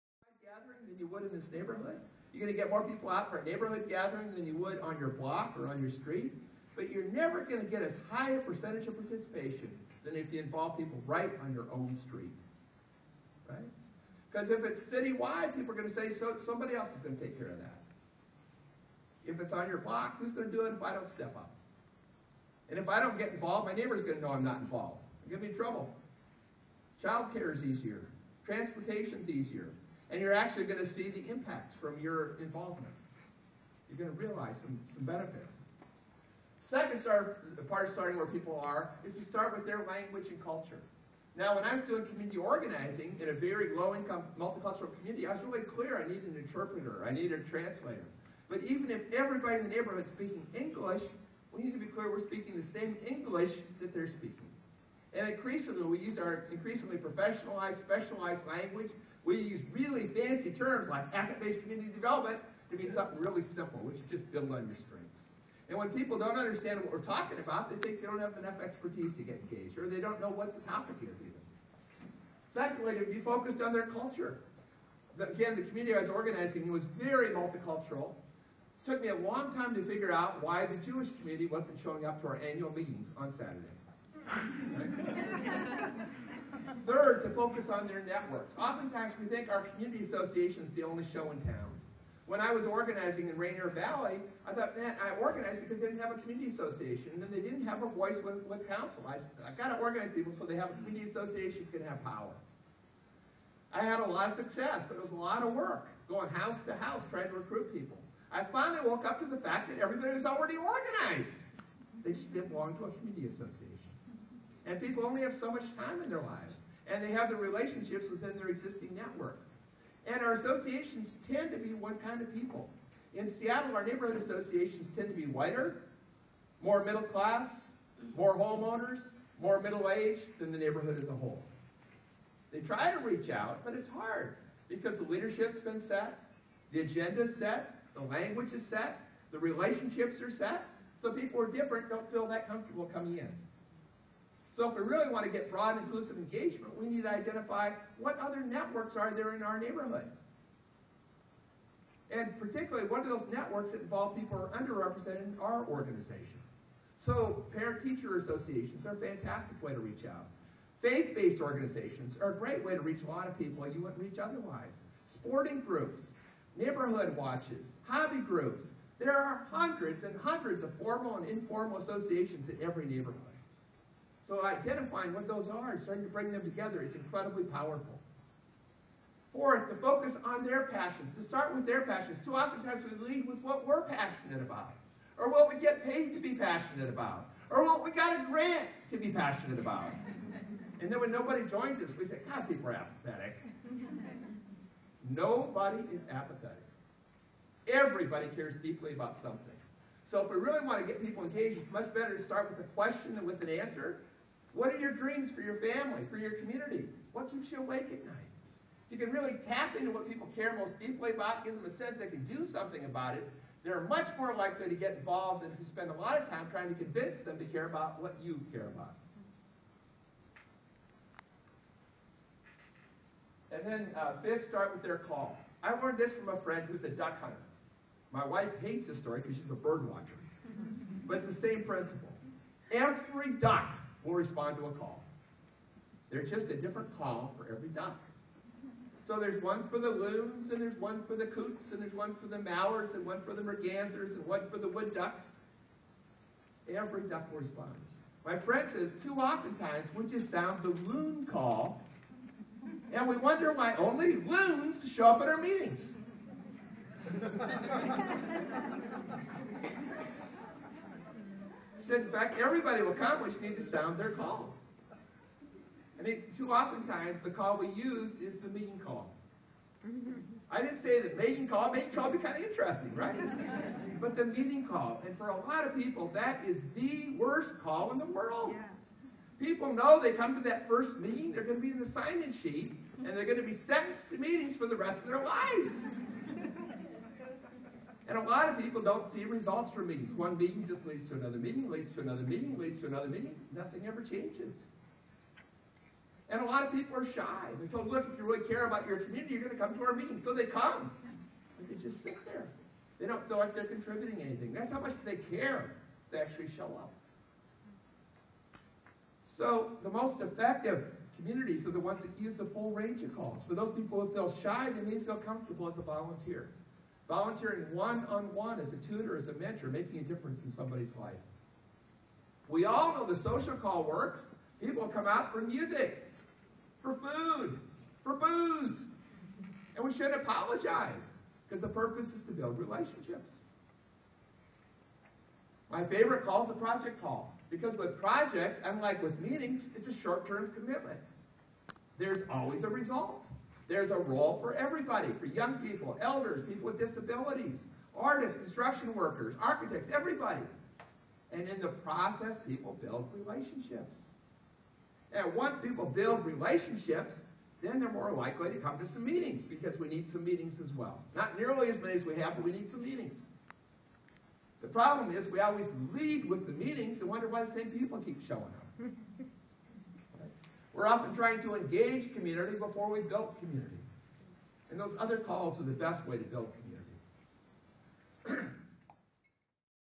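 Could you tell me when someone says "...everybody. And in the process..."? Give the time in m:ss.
5:49.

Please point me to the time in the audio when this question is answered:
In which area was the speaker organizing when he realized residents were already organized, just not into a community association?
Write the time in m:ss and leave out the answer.
1:33.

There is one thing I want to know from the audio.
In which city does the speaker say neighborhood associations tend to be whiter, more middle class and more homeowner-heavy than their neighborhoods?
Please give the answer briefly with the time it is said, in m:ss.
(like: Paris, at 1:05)
Seattle, at 2:03.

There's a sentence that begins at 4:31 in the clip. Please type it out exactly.
Meeting call would be kind of interesting, right?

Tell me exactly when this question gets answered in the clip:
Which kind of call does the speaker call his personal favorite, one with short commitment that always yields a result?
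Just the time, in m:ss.
5:36.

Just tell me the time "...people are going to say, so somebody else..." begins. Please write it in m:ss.
0:15.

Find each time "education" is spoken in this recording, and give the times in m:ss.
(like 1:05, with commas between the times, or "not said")
not said.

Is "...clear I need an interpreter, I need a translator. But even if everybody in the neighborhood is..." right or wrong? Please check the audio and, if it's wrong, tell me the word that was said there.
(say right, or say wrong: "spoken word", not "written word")
right.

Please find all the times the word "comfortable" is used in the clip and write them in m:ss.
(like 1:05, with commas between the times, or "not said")
2:22, 5:15.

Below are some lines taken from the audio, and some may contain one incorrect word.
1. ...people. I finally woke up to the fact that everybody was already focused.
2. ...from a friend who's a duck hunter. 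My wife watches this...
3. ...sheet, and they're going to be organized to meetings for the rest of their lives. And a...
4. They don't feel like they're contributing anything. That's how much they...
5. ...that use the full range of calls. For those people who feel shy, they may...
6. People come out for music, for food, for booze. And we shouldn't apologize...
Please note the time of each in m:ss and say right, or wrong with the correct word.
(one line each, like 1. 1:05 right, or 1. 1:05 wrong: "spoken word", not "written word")
1. 1:47 wrong: "organized", not "focused"
2. 3:46 wrong: "hates", not "watches"
3. 4:42 wrong: "sentenced", not "organized"
4. 5:02 right
5. 5:12 right
6. 5:24 right.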